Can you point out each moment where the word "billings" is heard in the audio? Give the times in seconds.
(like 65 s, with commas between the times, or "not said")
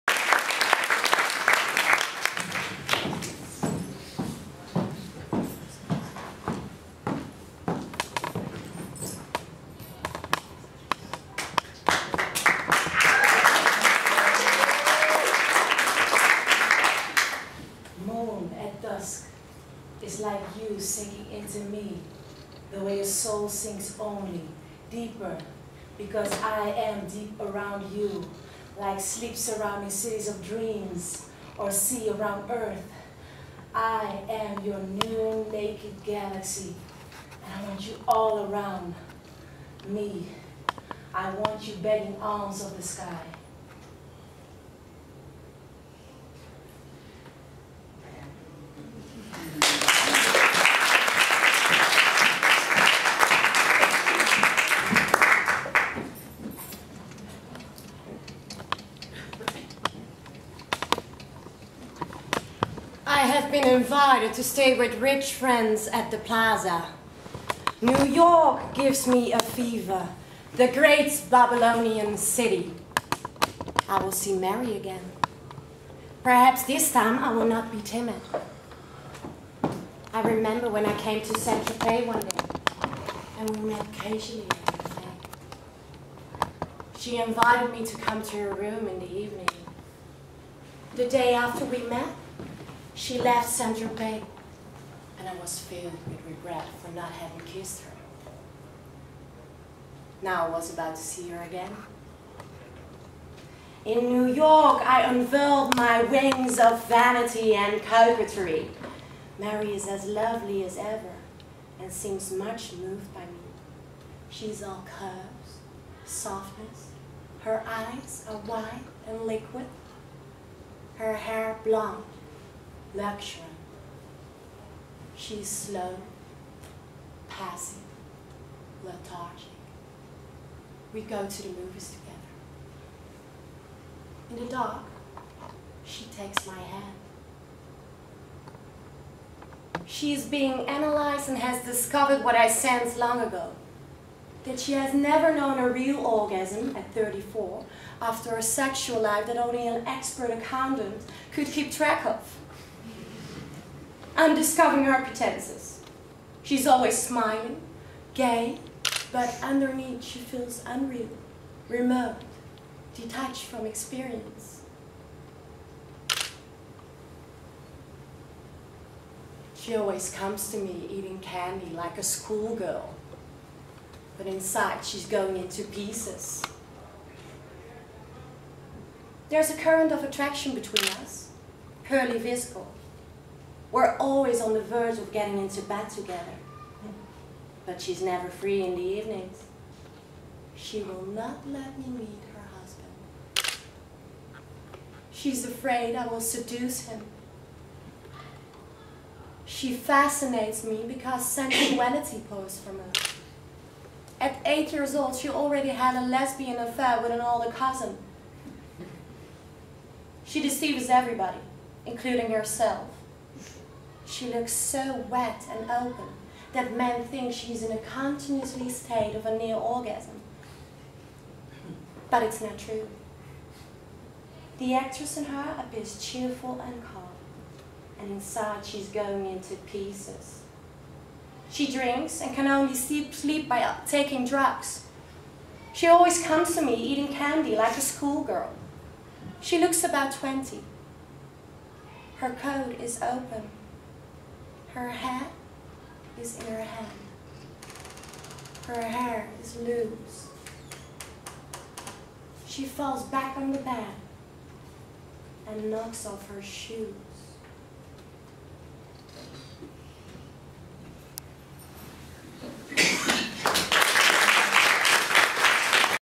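not said.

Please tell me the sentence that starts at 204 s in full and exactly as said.
At eight years old, she already had a lesbian affair with an older cousin.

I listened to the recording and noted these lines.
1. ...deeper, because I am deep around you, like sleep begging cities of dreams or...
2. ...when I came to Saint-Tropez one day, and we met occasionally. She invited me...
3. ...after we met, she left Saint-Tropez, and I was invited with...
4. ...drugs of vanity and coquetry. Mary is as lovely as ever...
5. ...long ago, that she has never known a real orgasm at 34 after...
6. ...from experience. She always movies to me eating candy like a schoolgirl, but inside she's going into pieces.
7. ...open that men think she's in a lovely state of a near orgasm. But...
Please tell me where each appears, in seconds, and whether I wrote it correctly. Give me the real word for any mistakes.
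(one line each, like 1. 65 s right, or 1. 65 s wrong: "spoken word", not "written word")
1. 24 s wrong: "surrounding", not "begging"
2. 80 s right
3. 91 s wrong: "filled", not "invited"
4. 106 s wrong: "wings", not "drugs"
5. 142 s right
6. 163 s wrong: "comes", not "movies"
7. 215 s wrong: "continuously", not "lovely".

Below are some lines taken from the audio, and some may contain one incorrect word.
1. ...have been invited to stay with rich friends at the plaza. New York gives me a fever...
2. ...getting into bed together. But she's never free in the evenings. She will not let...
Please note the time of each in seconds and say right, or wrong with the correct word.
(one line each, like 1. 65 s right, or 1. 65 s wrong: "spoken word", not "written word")
1. 63 s right
2. 185 s right.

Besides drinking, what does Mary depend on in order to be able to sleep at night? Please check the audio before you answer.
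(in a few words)
drugs.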